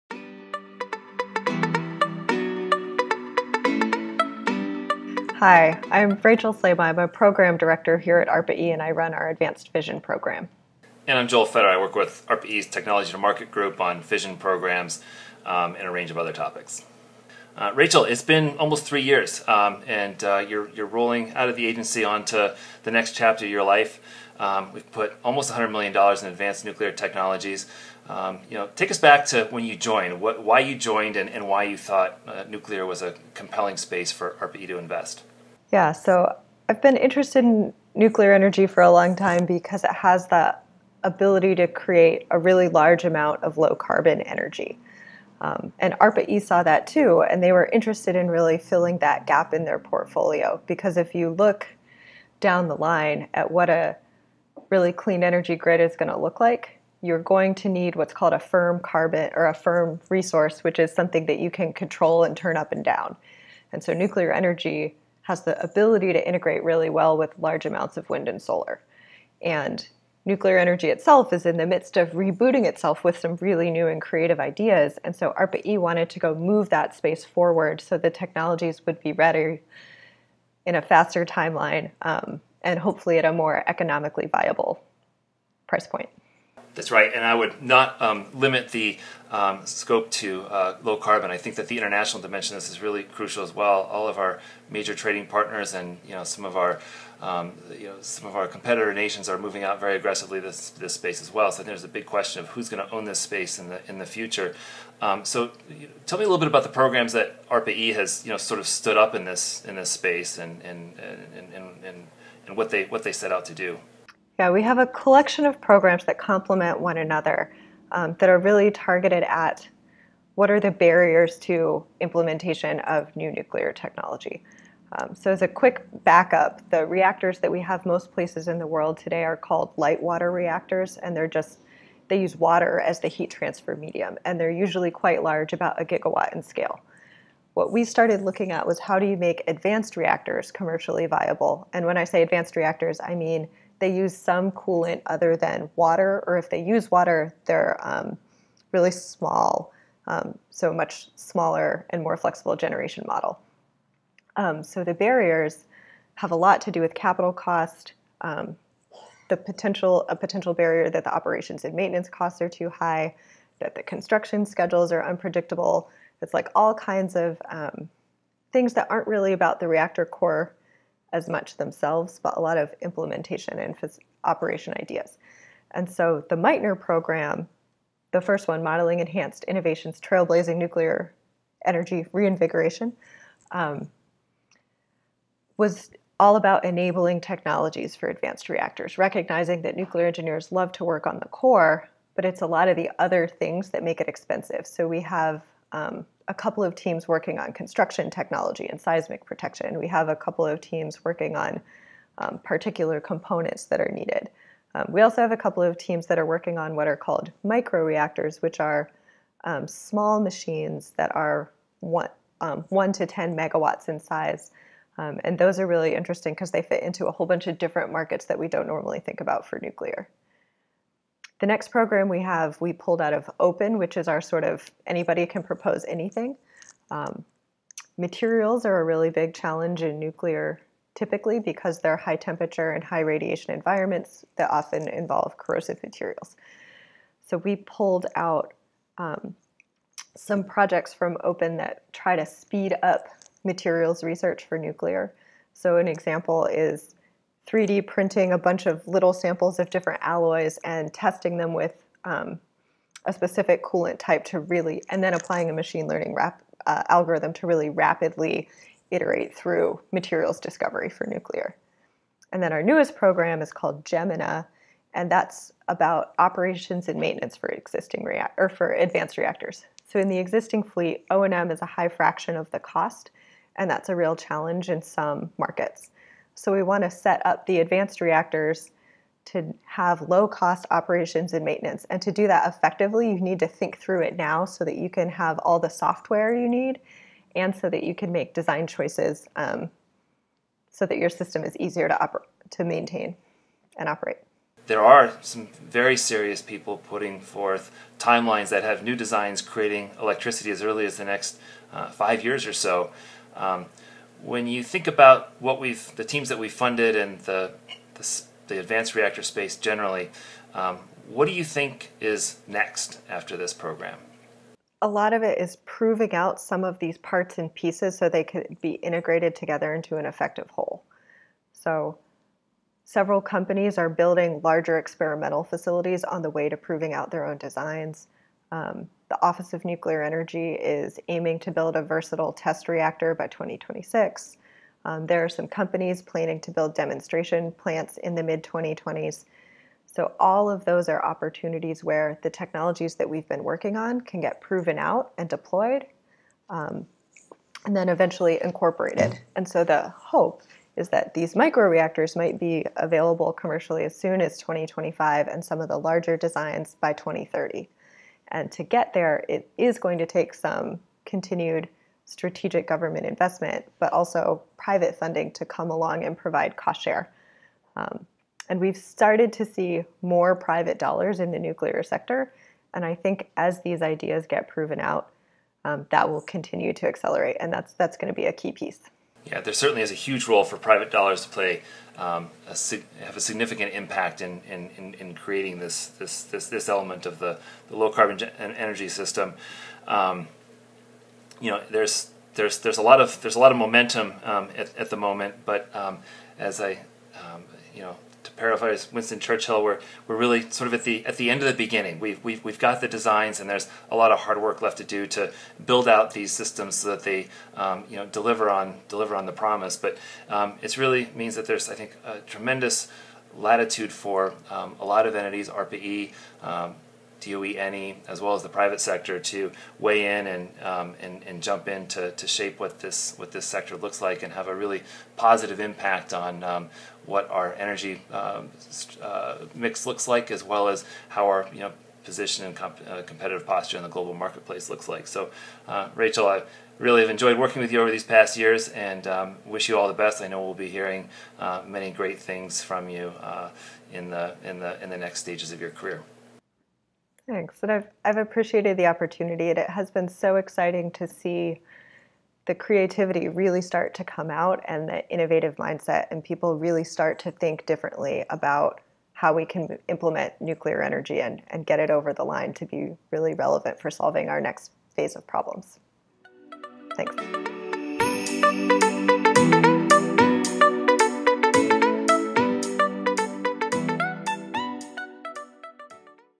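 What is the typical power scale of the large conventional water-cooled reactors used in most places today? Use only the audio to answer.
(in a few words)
1 gigawatt.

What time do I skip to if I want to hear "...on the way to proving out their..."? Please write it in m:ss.
5:26.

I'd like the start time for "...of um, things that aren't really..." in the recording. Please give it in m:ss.
2:47.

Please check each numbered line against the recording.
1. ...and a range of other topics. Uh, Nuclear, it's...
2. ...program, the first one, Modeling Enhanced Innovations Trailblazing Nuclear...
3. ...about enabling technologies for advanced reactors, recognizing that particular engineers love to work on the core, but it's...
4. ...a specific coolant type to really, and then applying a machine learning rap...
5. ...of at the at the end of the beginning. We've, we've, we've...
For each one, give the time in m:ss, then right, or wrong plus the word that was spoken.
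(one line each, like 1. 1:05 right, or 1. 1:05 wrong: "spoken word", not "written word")
1. 0:15 wrong: "Rachel", not "Nuclear"
2. 2:56 right
3. 3:06 wrong: "nuclear", not "particular"
4. 4:13 right
5. 6:40 right.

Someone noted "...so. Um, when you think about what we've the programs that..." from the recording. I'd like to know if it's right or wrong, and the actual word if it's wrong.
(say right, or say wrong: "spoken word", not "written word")
wrong: "teams", not "programs".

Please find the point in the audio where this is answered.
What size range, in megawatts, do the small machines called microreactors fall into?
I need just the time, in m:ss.
3:32.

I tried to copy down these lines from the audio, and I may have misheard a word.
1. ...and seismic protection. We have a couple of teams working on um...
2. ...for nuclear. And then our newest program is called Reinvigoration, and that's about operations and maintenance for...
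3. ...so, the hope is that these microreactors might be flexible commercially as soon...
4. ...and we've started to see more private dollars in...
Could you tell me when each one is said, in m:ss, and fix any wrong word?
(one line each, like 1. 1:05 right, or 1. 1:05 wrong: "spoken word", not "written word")
1. 3:18 right
2. 4:20 wrong: "Gemina", not "Reinvigoration"
3. 5:49 wrong: "available", not "flexible"
4. 6:08 right.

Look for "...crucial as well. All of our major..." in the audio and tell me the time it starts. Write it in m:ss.
1:33.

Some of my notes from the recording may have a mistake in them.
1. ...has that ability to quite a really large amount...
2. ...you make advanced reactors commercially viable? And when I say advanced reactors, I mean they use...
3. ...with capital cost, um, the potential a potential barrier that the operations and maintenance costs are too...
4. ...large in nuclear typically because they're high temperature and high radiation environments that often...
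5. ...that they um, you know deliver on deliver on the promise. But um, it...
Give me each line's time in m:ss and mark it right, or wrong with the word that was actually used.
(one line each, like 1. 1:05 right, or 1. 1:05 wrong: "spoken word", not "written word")
1. 0:39 wrong: "create", not "quite"
2. 2:19 right
3. 2:36 right
4. 3:49 wrong: "challenge", not "large"
5. 6:46 right.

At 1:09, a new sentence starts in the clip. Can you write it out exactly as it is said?
And nuclear energy itself is in the midst of rebooting itself with some really new and creative ideas.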